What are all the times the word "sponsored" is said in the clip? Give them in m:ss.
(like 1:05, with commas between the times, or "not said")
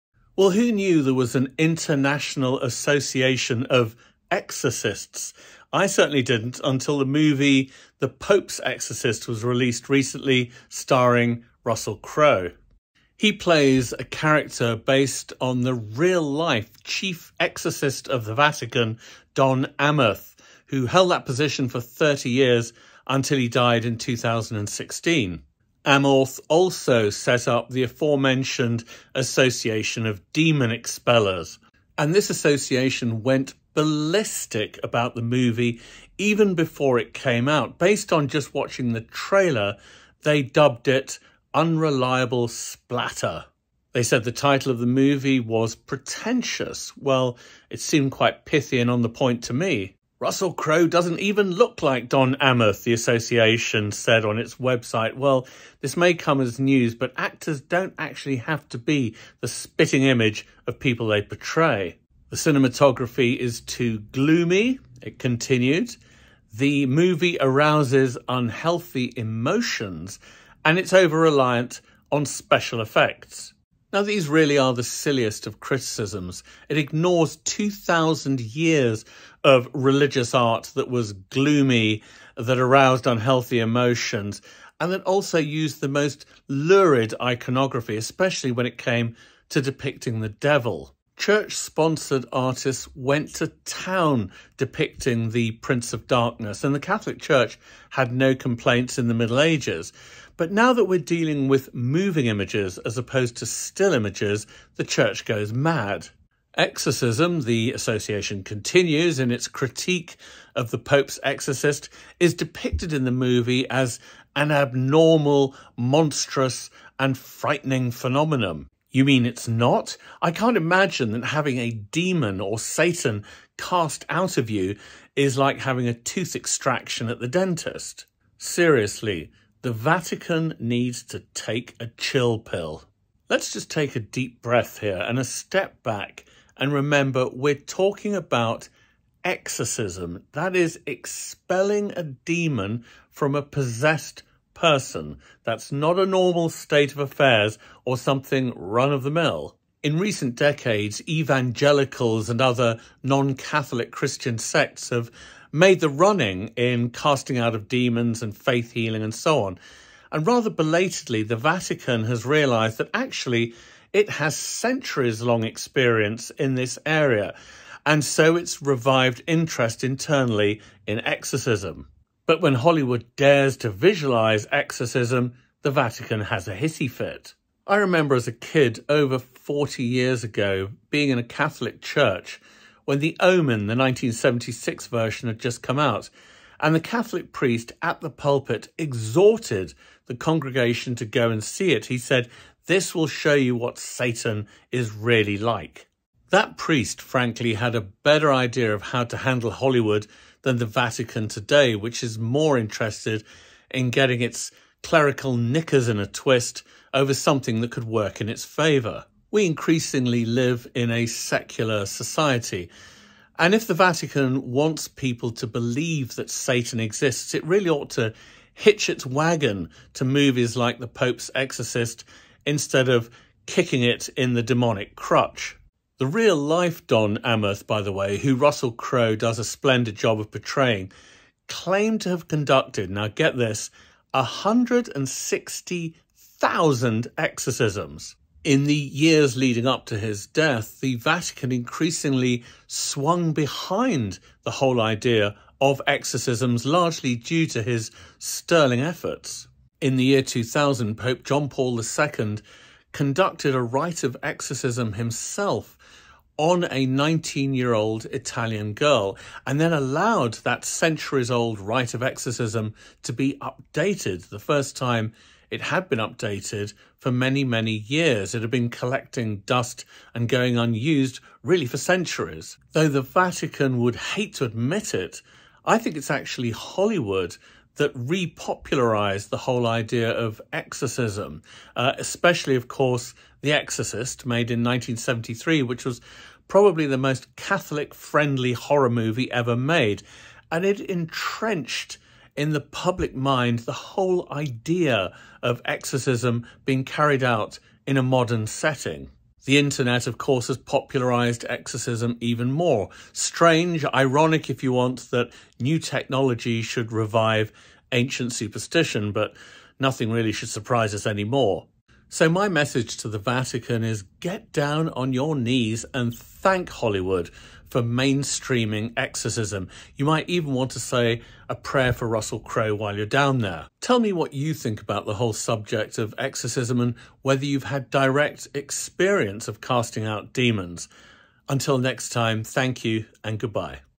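1:31.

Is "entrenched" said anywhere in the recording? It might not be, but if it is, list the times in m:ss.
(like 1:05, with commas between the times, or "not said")
4:50.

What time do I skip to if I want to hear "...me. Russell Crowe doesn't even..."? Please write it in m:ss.
0:49.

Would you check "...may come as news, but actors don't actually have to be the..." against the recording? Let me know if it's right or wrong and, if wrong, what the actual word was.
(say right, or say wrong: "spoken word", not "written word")
right.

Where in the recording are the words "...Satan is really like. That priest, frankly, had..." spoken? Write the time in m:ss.
3:13.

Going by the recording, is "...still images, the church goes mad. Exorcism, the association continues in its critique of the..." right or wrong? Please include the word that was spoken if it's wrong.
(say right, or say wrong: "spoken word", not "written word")
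right.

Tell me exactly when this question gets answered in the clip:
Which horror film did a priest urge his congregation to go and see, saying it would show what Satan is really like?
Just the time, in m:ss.
3:02.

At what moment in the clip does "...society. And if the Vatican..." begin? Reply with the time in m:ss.
3:31.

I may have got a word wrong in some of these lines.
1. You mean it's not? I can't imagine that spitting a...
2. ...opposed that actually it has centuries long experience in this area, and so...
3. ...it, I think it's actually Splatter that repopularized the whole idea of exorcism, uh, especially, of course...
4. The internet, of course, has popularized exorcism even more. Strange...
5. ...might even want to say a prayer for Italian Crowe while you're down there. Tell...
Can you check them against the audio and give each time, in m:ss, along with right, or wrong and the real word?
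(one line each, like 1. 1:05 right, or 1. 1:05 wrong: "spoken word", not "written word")
1. 1:58 wrong: "having", not "spitting"
2. 2:42 wrong: "realised", not "opposed"
3. 4:34 wrong: "Hollywood", not "Splatter"
4. 4:59 right
5. 5:20 wrong: "Russell", not "Italian".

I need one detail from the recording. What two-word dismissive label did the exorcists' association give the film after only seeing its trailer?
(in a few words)
Unreliable Splatter.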